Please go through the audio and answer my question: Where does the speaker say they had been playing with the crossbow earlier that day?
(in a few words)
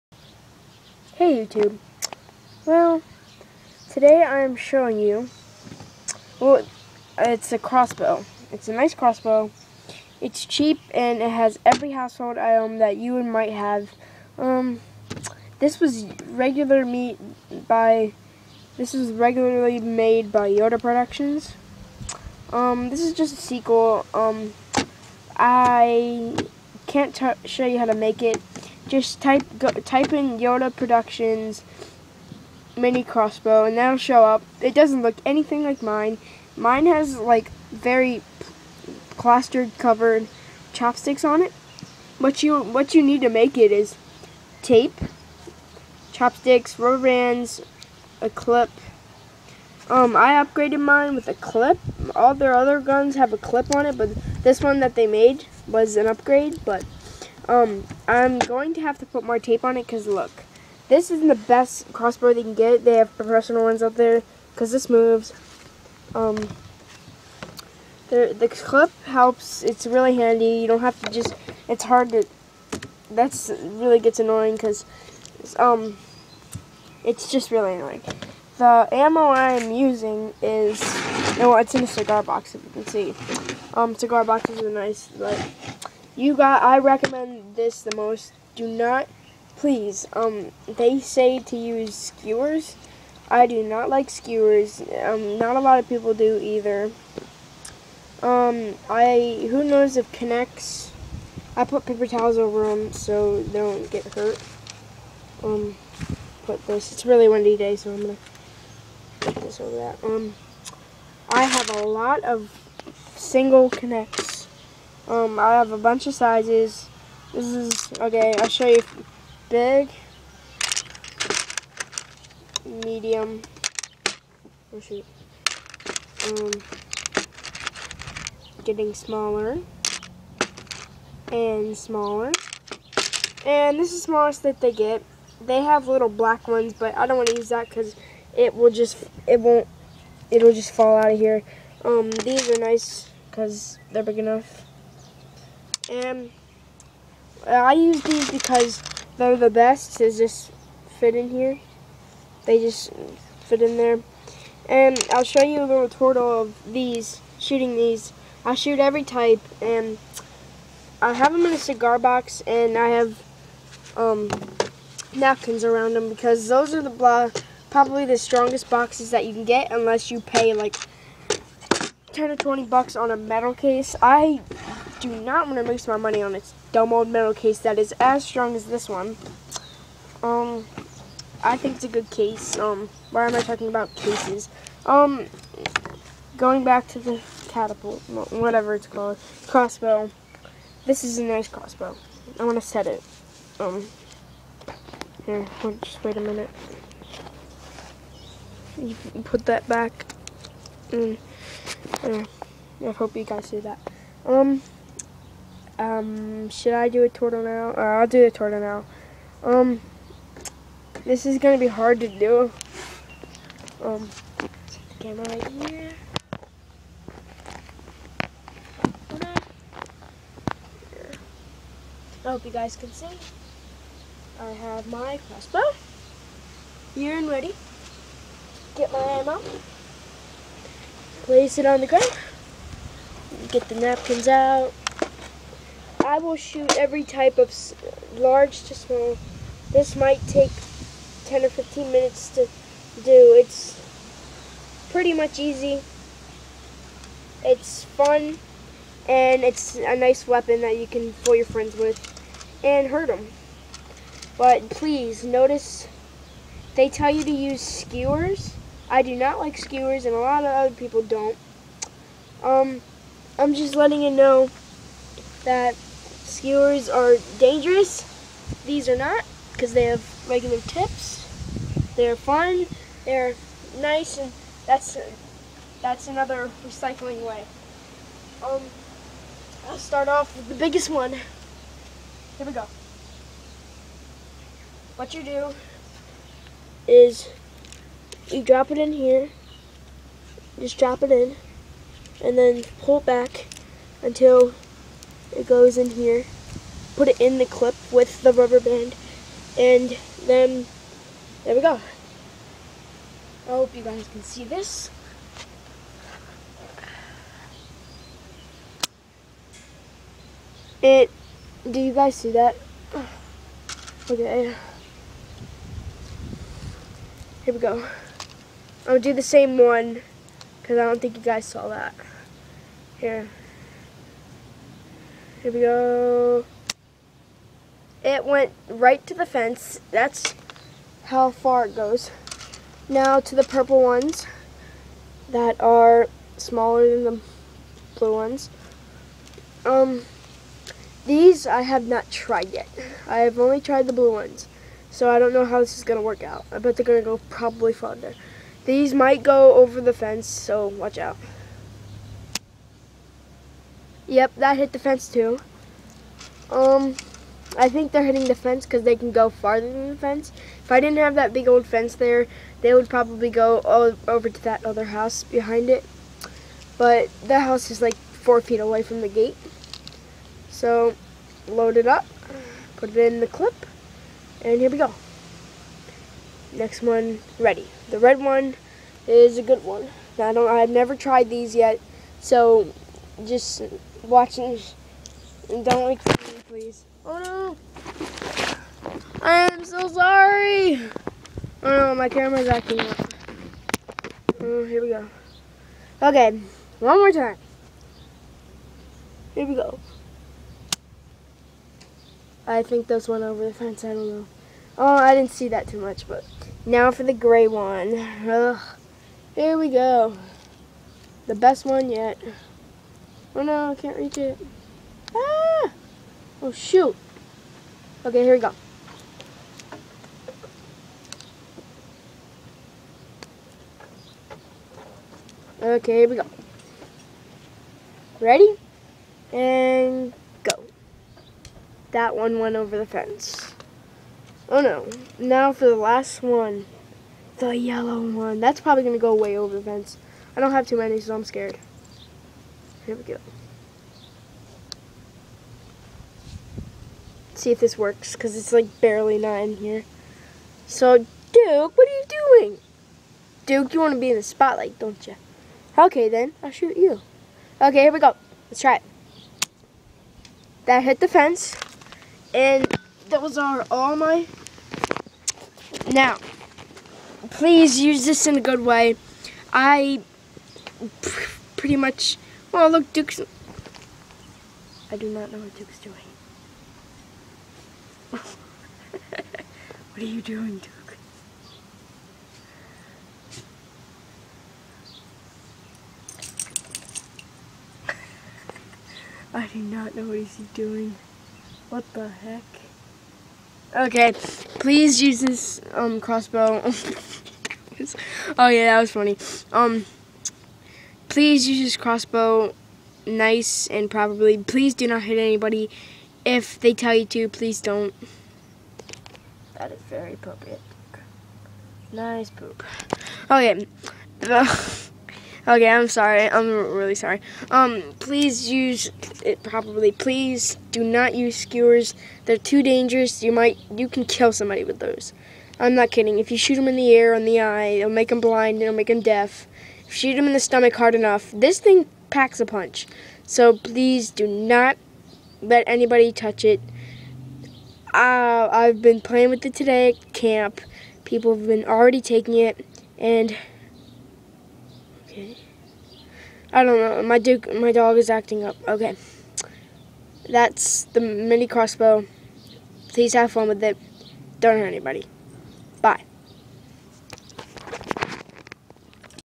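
At camp.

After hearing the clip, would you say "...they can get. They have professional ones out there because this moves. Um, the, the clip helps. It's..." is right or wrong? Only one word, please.
right.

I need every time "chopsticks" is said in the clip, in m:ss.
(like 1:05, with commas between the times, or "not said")
0:40, 0:46.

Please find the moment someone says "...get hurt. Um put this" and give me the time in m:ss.
1:43.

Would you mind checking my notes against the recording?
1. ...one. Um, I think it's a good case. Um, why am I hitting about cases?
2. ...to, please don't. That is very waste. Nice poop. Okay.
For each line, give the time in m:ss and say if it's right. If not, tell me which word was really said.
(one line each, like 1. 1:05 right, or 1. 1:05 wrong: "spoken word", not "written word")
1. 2:58 wrong: "talking", not "hitting"
2. 8:27 wrong: "appropriate", not "waste".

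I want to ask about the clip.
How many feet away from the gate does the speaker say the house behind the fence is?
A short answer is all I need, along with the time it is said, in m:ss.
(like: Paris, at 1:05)
4, at 6:07.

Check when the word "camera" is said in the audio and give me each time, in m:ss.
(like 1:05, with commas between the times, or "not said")
3:34, 6:32.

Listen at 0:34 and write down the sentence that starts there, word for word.
It doesn't look anything like mine.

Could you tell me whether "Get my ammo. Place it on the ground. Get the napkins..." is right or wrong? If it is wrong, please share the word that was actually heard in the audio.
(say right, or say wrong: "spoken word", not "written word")
right.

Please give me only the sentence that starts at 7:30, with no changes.
So, Duke, what are you doing?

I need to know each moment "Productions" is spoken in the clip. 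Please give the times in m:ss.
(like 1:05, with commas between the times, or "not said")
0:20, 0:30.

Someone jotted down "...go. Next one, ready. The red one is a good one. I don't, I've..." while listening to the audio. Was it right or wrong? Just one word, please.
right.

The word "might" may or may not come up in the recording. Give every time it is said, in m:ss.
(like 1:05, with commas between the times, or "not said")
0:13, 3:59, 5:48, 8:43.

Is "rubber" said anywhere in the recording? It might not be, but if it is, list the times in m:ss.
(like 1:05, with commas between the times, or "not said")
0:46, 4:58.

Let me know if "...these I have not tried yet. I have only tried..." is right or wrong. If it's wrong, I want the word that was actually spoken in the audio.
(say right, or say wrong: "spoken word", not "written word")
right.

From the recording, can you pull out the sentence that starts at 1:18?
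The ammo I'm using is, no, it's in a cigar box if you can see.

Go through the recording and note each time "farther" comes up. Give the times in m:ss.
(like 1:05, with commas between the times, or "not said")
5:47, 5:59.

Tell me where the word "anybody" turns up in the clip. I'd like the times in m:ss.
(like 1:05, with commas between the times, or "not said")
8:25, 8:55, 9:14.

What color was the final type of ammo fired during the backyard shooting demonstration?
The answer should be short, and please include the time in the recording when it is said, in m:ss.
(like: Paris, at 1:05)
Yellow, at 7:17.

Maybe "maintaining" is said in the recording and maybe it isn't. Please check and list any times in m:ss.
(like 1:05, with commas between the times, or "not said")
not said.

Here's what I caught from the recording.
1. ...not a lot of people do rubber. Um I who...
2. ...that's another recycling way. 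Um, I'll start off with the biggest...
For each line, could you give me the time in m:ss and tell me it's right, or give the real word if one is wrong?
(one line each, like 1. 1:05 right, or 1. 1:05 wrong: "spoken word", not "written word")
1. 1:35 wrong: "either", not "rubber"
2. 4:35 right.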